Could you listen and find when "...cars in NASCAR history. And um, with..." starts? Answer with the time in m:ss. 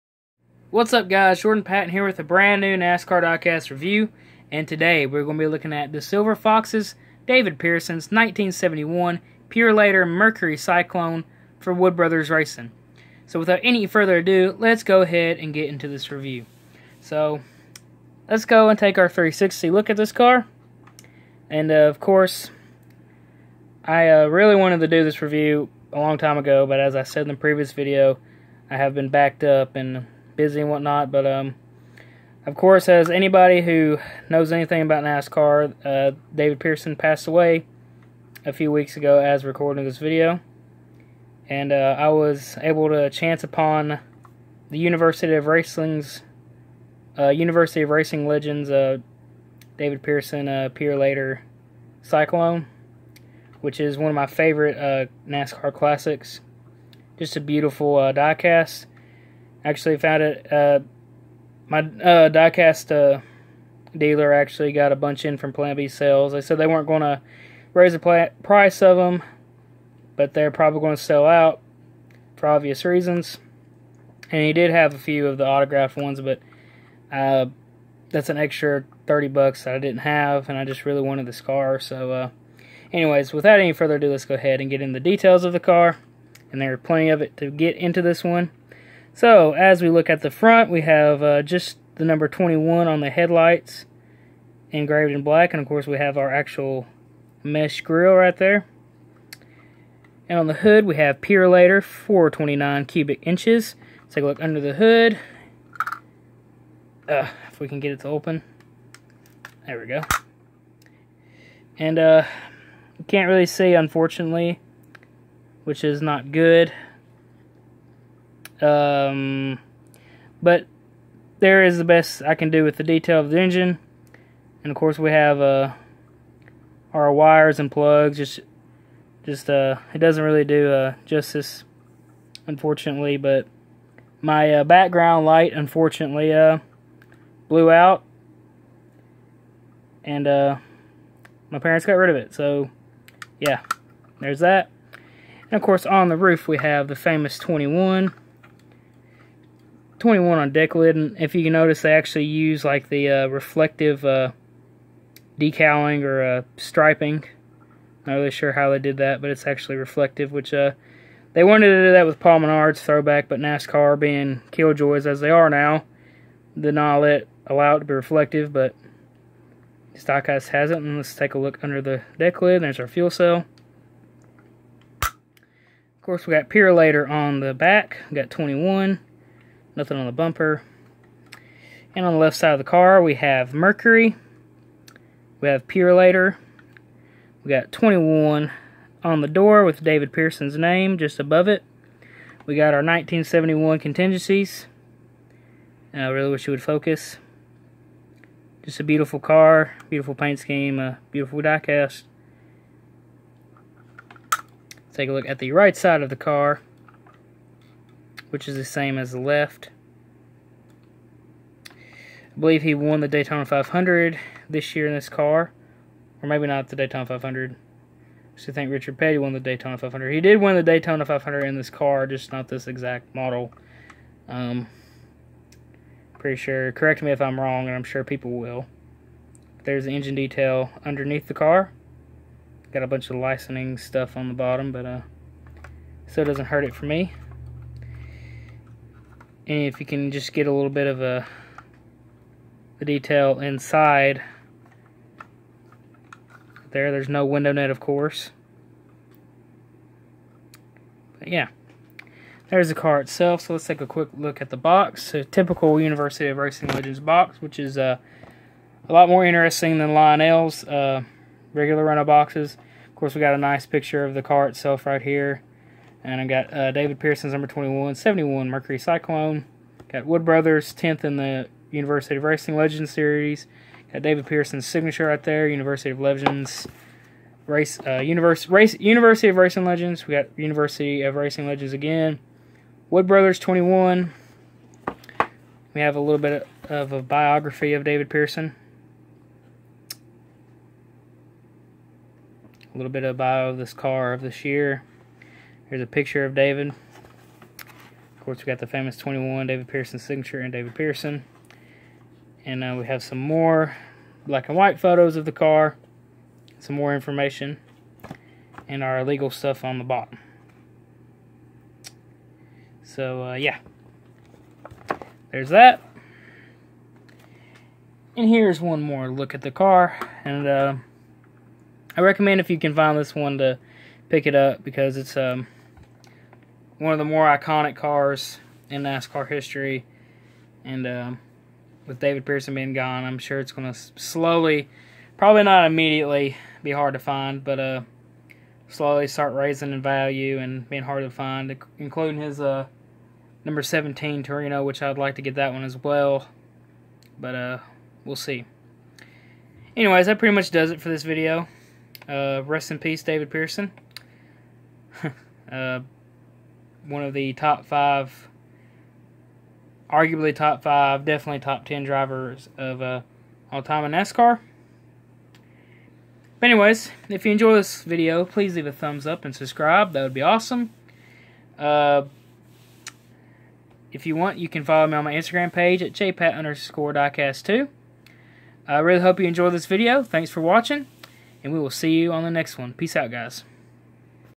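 5:27.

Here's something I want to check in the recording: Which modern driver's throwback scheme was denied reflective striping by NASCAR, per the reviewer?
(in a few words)
Paul Menard.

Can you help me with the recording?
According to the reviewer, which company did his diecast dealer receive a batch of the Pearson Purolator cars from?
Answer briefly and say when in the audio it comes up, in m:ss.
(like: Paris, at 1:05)
Plan B sales, at 1:05.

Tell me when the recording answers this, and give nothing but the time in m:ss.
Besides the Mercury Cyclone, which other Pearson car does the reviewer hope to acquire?
5:43.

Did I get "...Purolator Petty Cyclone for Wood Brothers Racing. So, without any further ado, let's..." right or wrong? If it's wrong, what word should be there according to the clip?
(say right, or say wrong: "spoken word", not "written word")
wrong: "Mercury", not "Petty".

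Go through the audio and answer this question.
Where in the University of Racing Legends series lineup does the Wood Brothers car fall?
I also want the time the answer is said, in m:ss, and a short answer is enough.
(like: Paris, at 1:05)
10th, at 4:30.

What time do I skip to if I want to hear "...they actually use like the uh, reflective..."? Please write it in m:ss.
2:31.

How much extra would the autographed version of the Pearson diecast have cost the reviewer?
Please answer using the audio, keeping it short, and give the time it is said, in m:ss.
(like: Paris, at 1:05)
30 bucks, at 1:19.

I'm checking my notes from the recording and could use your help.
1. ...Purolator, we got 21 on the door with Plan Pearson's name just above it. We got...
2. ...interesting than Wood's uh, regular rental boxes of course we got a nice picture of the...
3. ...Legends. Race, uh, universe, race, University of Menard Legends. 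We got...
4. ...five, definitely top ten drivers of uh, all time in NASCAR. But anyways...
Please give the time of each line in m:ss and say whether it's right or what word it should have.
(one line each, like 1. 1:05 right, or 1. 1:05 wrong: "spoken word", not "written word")
1. 3:05 wrong: "David", not "Plan"
2. 4:19 wrong: "Lionel", not "Wood"
3. 4:35 wrong: "Racing", not "Menard"
4. 6:00 right.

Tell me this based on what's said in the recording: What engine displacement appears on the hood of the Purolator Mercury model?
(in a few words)
429 cubic inches.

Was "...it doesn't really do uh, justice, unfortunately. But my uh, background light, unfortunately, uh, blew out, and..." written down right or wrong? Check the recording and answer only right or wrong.
right.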